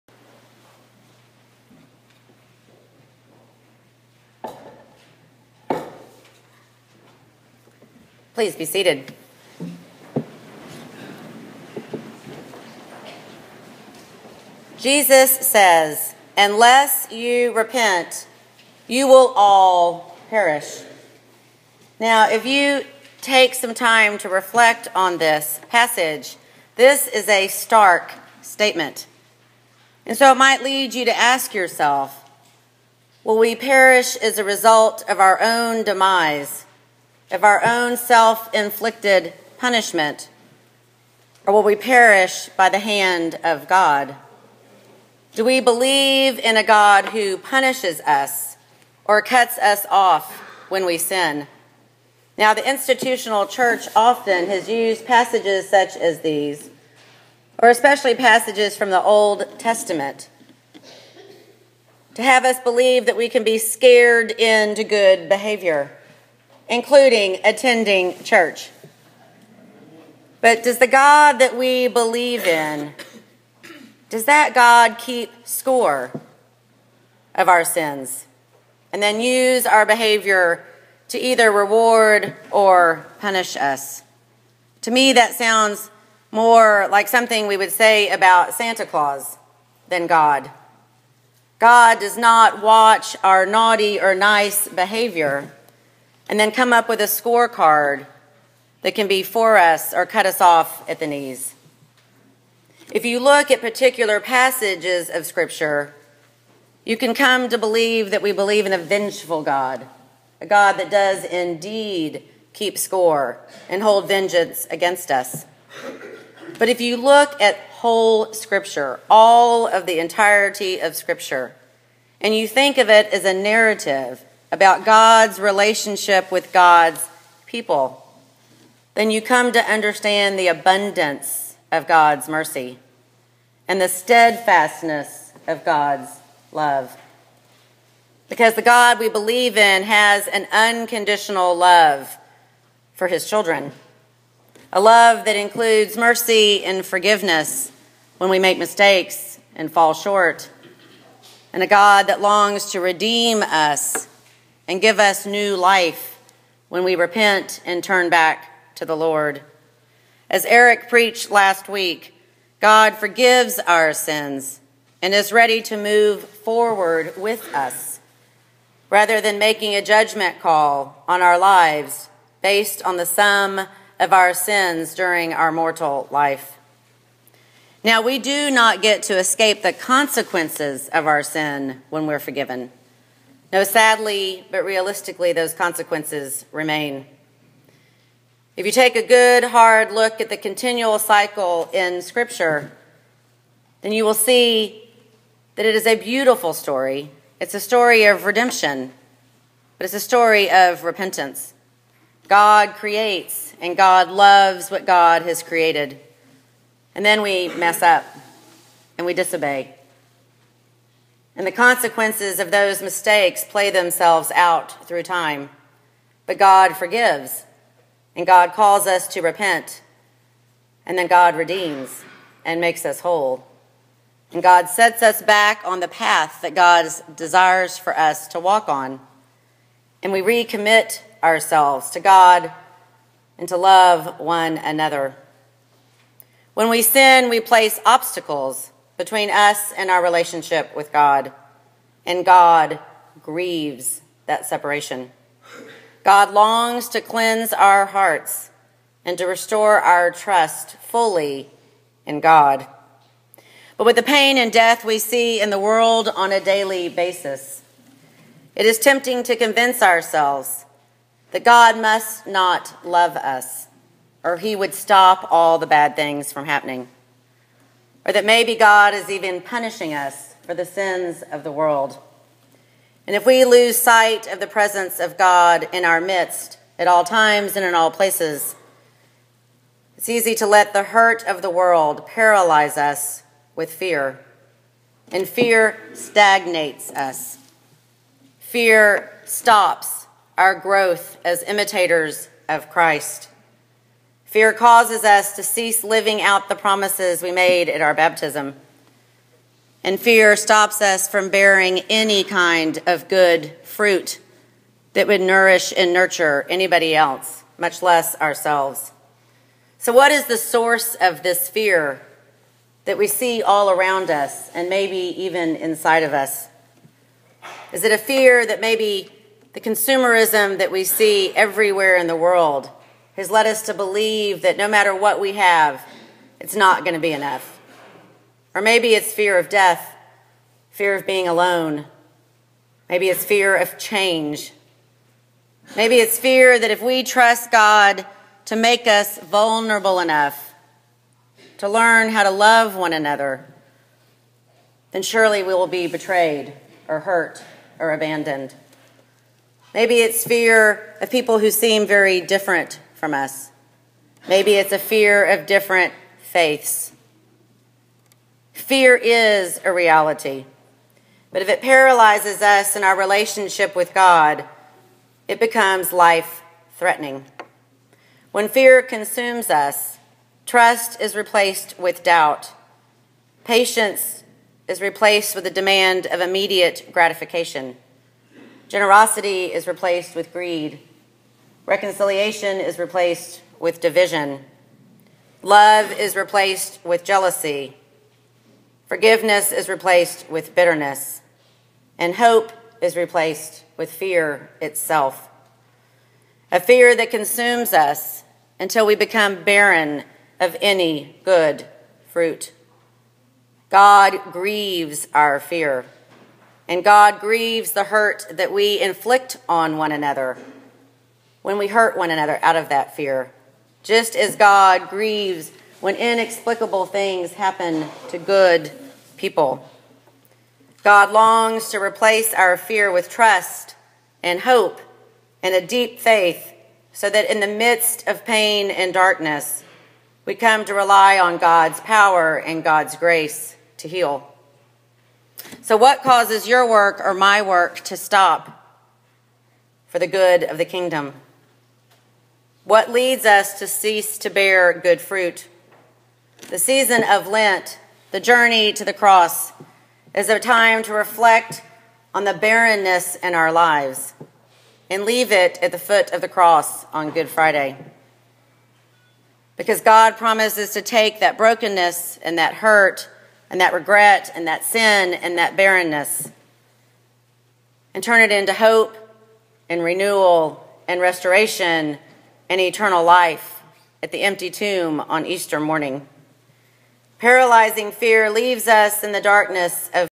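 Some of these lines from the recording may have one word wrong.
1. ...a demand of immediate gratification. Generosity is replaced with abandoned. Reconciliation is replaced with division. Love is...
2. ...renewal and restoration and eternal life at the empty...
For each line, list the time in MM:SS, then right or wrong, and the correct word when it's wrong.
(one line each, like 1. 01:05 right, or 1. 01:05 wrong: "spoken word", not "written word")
1. 06:15 wrong: "greed", not "abandoned"
2. 07:49 right.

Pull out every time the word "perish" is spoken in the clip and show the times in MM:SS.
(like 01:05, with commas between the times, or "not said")
00:20, 00:33, 00:41.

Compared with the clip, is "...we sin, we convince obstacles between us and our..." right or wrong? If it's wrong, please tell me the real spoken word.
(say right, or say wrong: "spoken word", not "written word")
wrong: "place", not "convince".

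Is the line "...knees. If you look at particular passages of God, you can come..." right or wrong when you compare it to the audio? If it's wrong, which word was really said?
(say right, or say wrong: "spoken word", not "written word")
wrong: "Scripture", not "God".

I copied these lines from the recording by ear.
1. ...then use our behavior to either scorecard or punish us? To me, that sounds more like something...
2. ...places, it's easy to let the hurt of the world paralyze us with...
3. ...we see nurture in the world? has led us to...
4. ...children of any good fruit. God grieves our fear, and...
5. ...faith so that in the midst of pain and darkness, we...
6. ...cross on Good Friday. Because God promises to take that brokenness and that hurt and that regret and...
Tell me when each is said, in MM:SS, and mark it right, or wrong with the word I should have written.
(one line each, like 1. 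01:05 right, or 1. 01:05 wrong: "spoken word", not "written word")
1. 01:19 wrong: "reward", not "scorecard"
2. 04:37 right
3. 05:20 wrong: "everywhere", not "nurture"
4. 06:39 wrong: "barren", not "children"
5. 07:05 right
6. 07:36 right.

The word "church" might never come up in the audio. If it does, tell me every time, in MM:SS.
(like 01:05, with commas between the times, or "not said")
00:53, 01:08.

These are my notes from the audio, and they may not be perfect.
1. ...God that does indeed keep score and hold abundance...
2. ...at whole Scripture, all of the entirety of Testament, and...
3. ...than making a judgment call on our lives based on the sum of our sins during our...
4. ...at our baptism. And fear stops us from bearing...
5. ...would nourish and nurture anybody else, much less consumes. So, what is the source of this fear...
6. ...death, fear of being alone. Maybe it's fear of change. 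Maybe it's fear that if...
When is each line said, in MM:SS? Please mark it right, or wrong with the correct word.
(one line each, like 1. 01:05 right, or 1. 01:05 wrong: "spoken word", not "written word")
1. 01:50 wrong: "vengeance", not "abundance"
2. 01:57 wrong: "Scripture", not "Testament"
3. 02:49 right
4. 04:57 right
5. 05:05 wrong: "ourselves", not "consumes"
6. 05:29 right.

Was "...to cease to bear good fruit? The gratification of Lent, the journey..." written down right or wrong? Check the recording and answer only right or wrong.
wrong.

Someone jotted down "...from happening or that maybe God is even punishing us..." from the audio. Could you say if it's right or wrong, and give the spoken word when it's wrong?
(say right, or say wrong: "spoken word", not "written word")
right.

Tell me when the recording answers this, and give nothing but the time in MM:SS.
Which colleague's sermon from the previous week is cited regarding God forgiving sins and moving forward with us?
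02:40.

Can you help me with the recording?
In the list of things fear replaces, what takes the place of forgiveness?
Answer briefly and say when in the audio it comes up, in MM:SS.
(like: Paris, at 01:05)
Bitterness, at 06:30.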